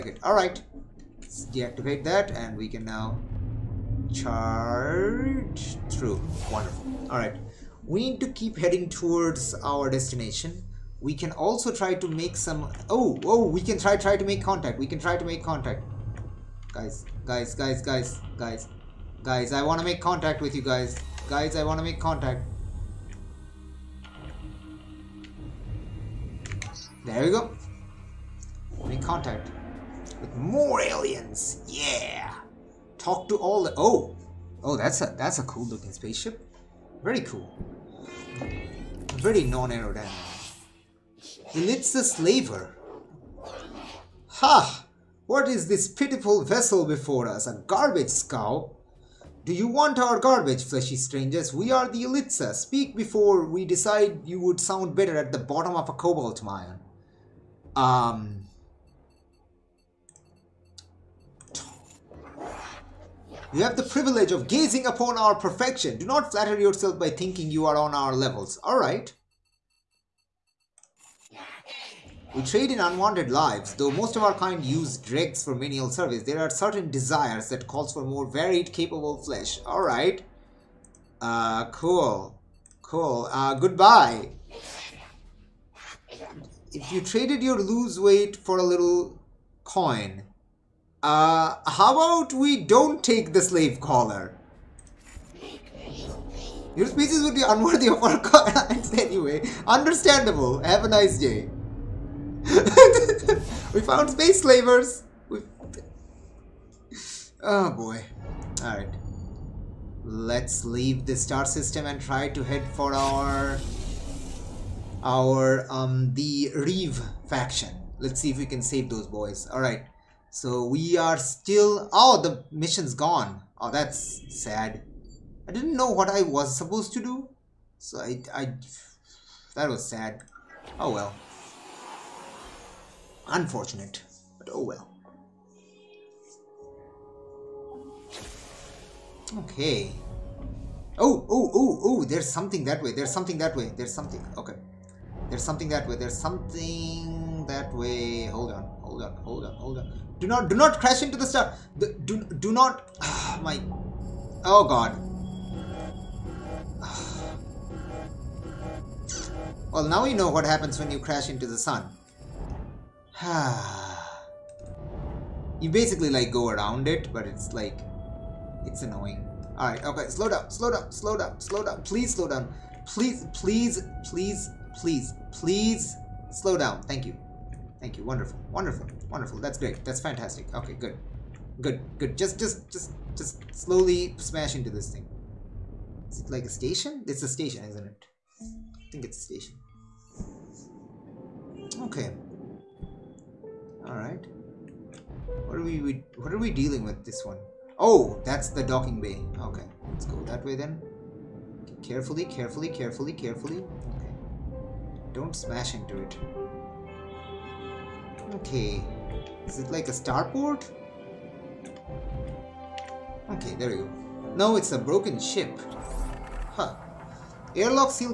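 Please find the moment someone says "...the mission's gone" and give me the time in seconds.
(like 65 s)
122 s.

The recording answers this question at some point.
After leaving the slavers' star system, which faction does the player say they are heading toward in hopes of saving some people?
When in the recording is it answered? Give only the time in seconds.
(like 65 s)
116 s.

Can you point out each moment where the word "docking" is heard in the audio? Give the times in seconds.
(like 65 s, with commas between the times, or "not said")
198 s.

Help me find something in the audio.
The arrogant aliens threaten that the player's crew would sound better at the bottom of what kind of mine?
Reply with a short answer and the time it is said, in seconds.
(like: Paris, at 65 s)
cobalt mine, at 55 s.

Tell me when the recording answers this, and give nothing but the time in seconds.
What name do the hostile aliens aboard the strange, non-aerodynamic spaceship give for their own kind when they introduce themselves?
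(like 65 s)
52 s.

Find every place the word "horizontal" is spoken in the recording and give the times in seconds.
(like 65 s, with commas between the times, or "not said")
not said.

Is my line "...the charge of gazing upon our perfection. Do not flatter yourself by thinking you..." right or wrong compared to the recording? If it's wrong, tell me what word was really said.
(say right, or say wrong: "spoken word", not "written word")
wrong: "privilege", not "charge".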